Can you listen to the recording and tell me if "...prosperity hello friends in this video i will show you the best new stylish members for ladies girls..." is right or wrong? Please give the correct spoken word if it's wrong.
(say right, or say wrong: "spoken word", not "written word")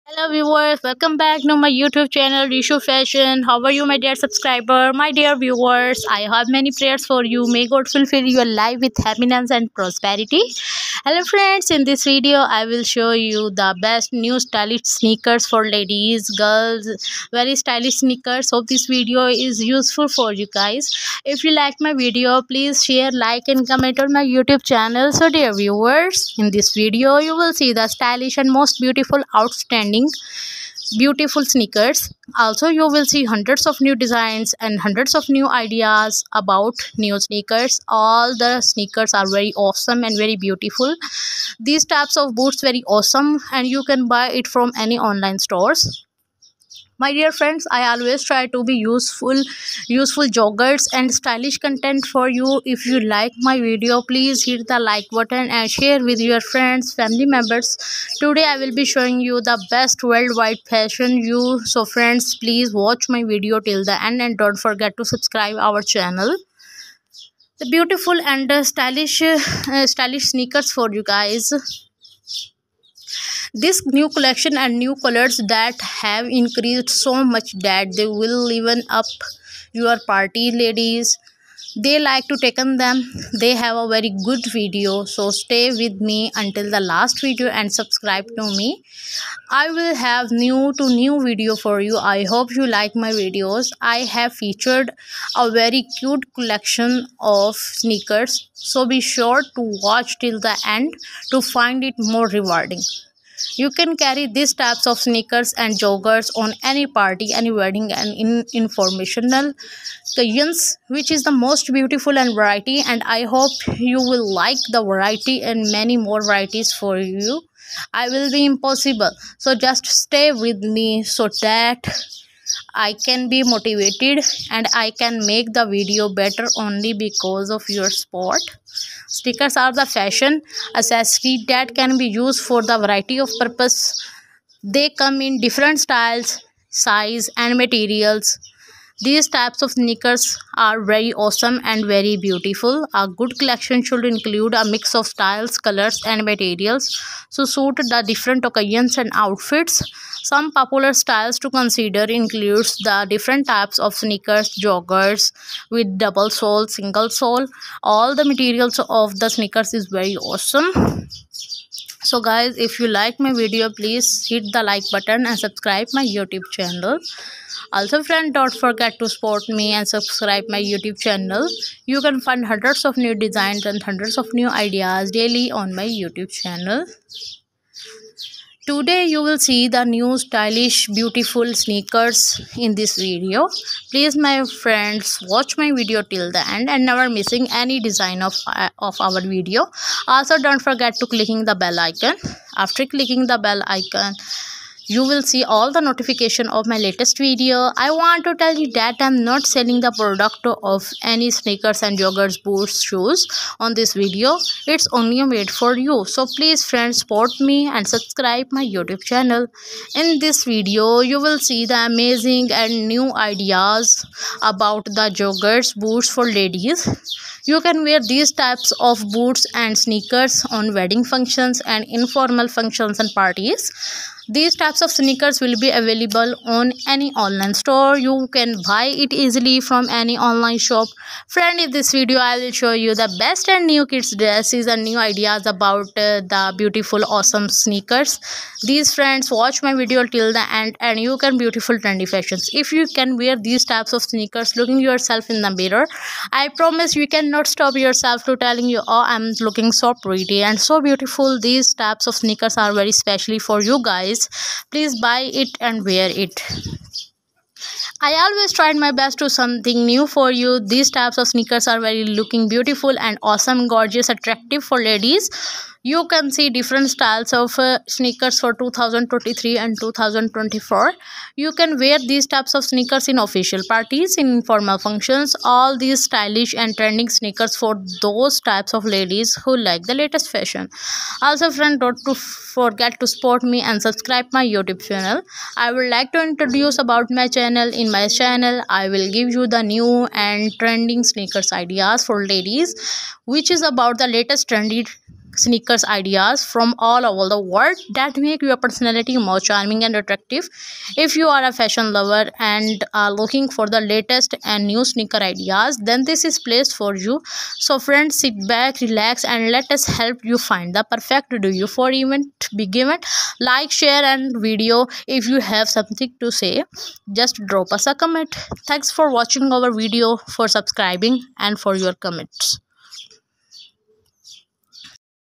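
wrong: "sneakers", not "members".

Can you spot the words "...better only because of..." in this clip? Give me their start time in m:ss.
2:06.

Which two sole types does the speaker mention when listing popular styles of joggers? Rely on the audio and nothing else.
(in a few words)
double sole, single sole.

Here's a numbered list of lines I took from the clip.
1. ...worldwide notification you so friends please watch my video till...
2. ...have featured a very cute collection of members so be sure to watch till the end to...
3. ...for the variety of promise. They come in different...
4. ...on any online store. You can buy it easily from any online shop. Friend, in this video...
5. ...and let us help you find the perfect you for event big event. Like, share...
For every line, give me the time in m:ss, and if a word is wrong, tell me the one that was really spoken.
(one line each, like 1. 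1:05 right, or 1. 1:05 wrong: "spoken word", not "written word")
1. 1:00 wrong: "fashion", not "notification"
2. 1:34 wrong: "sneakers", not "members"
3. 2:12 wrong: "purpose", not "promise"
4. 3:46 right
5. 5:09 right.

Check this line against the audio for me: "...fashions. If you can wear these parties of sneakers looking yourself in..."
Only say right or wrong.
wrong.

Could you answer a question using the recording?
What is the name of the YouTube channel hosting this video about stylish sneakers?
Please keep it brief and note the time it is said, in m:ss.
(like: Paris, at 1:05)
Reshu fashion, at 0:02.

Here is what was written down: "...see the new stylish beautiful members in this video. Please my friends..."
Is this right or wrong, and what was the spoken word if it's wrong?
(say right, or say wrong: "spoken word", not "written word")
wrong: "sneakers", not "members".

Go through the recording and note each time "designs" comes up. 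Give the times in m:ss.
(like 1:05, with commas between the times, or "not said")
0:33, 2:53, 3:07.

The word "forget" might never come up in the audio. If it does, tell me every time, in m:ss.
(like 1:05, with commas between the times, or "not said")
1:04, 2:48, 3:10, 4:42.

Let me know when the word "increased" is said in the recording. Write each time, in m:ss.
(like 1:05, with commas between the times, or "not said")
1:16.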